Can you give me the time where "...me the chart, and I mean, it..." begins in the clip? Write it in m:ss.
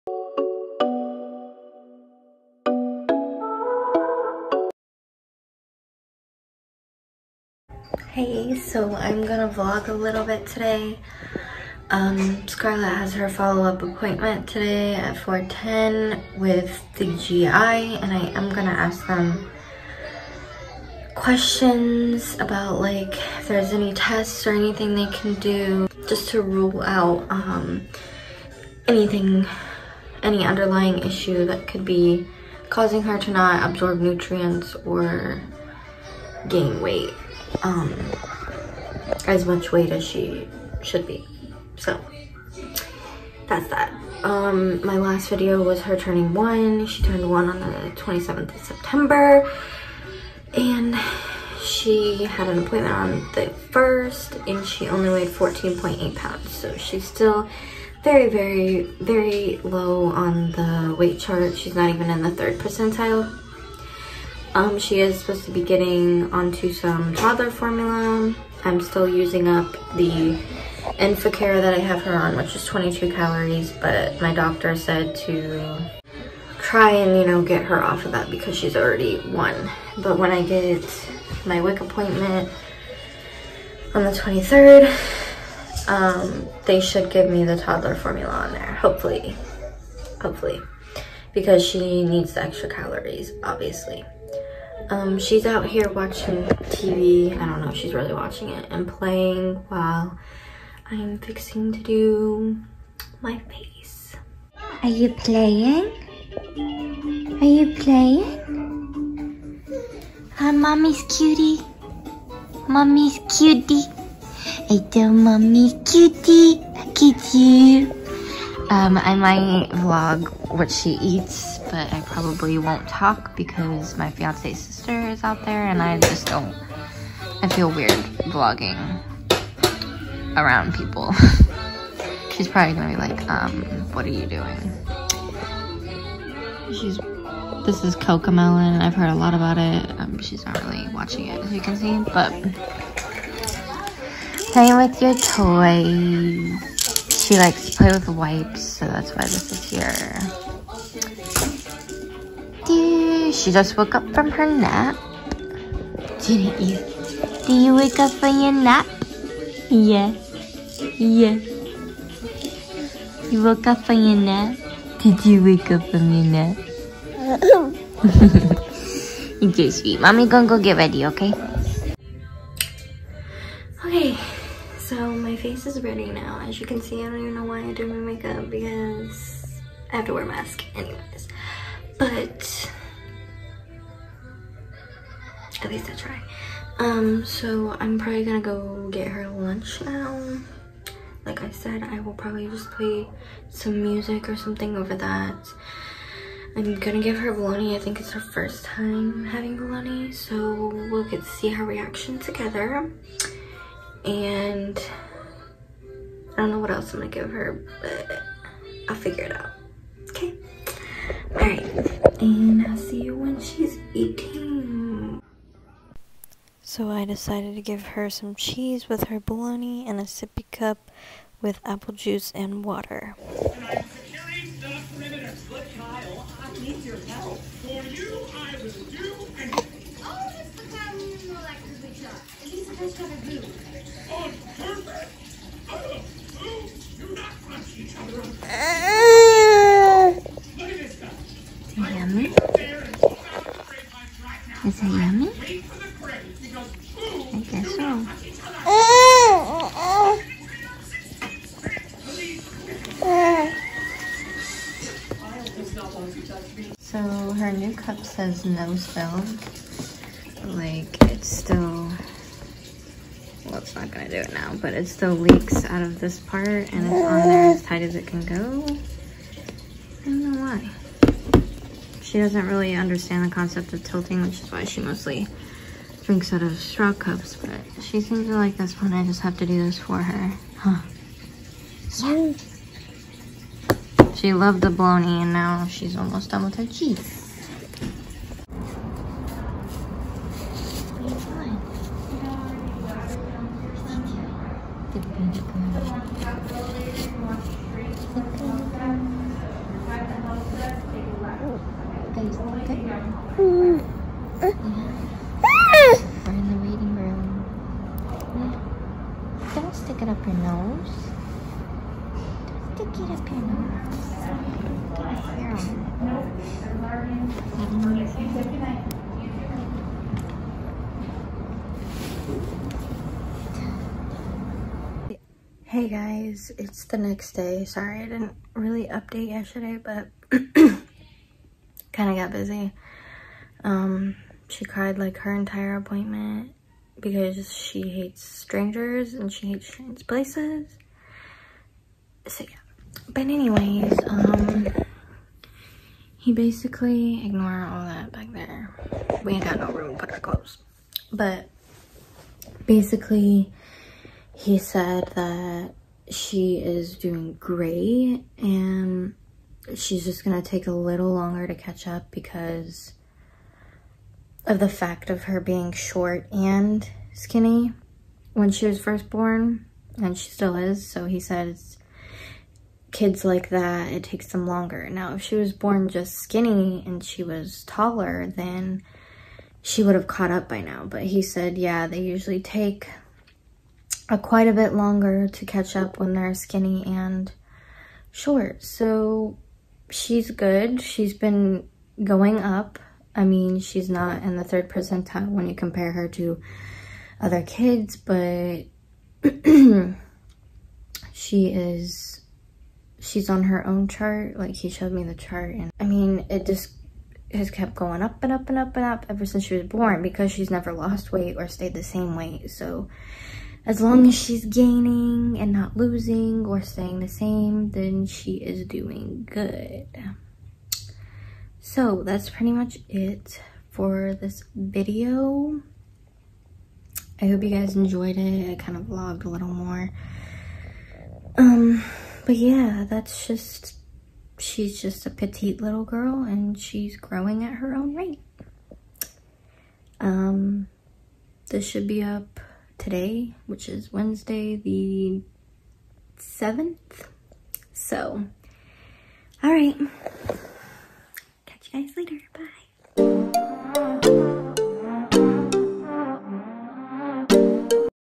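6:44.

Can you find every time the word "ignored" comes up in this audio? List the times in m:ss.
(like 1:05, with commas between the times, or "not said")
5:47.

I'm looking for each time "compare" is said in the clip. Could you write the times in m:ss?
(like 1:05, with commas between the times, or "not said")
6:35.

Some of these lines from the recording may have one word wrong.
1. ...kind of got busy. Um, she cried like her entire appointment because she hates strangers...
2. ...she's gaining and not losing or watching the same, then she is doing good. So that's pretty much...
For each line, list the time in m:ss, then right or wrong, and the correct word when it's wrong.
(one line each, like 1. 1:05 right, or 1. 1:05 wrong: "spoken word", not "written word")
1. 5:31 right
2. 6:54 wrong: "staying", not "watching".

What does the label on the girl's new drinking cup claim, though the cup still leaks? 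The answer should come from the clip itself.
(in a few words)
No spill.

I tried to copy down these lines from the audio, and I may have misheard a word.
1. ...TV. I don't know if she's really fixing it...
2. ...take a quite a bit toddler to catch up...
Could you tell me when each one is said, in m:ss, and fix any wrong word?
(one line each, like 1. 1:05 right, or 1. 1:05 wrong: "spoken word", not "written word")
1. 1:36 wrong: "watching", not "fixing"
2. 6:22 wrong: "longer", not "toddler".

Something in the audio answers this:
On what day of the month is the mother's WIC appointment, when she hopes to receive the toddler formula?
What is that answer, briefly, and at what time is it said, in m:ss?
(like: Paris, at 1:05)
23rd, at 1:24.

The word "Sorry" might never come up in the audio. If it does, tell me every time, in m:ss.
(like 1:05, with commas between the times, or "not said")
5:27.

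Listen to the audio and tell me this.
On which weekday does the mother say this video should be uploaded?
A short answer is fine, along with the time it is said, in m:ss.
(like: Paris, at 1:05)
Wednesday, at 7:23.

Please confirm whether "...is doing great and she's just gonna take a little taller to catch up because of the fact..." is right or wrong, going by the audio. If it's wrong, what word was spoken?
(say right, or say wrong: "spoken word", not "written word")
wrong: "longer", not "taller".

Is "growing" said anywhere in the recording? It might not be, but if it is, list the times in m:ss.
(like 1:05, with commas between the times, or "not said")
7:16.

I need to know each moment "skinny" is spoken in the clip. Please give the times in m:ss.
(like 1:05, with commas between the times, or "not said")
6:07, 6:16, 6:26.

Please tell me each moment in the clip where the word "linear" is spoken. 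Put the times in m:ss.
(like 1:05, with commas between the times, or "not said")
not said.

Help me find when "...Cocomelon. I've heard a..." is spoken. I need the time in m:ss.
2:17.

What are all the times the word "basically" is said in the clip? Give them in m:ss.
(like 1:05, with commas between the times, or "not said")
5:46, 5:52.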